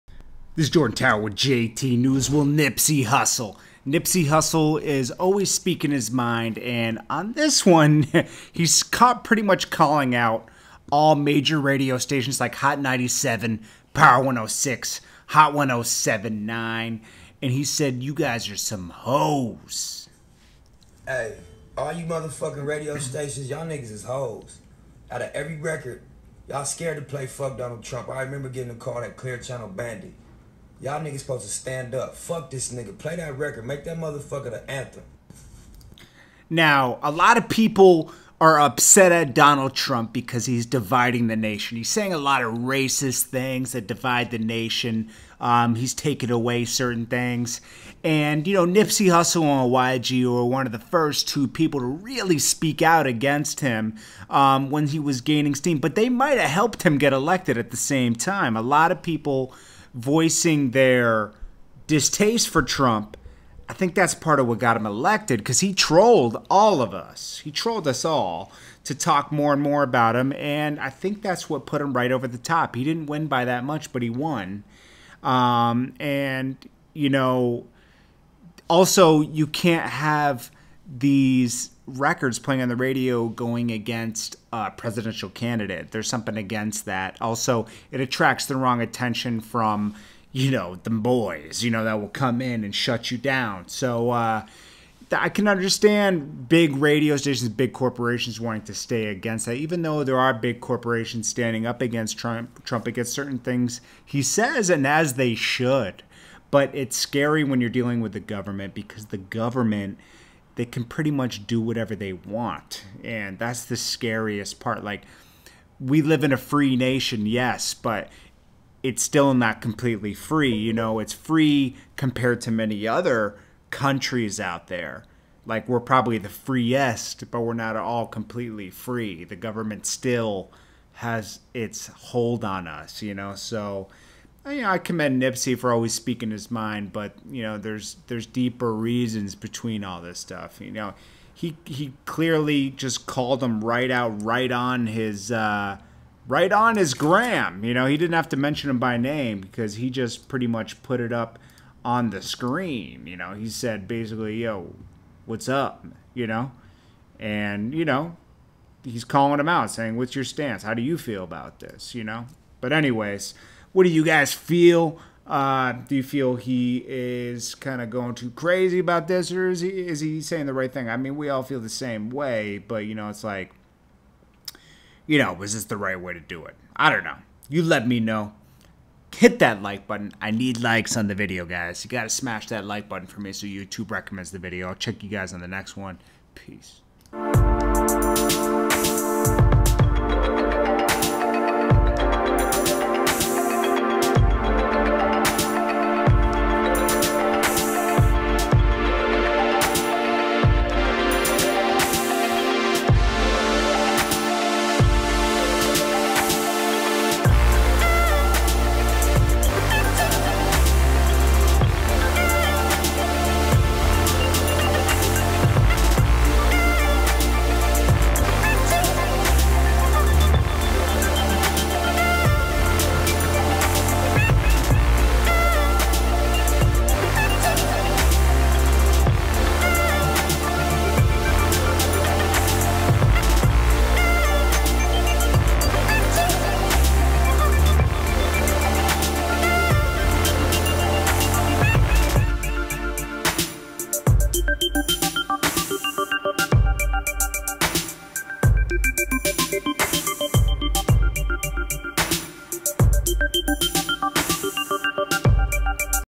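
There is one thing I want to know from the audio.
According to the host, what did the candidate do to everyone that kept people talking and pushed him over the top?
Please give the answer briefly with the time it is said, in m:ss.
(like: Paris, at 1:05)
Trolled us, at 1:07.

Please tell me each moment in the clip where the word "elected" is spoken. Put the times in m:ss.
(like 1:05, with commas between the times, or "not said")
0:57, 1:04.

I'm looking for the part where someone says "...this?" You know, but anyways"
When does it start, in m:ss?
2:41.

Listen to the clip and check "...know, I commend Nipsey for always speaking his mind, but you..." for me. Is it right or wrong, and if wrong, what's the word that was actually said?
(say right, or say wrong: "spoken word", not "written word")
right.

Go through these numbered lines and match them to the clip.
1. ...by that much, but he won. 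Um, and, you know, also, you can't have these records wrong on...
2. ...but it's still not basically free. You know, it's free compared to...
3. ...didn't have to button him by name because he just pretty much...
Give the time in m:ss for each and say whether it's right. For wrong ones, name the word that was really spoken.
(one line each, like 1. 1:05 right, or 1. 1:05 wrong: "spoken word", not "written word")
1. 1:13 wrong: "playing", not "wrong"
2. 1:57 wrong: "completely", not "basically"
3. 2:27 wrong: "mention", not "button".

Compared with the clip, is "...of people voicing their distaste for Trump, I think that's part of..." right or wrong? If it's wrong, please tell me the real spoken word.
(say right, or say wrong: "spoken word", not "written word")
right.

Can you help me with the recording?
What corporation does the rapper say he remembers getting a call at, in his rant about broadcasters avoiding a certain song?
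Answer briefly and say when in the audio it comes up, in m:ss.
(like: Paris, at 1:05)
Clear Channel, at 0:29.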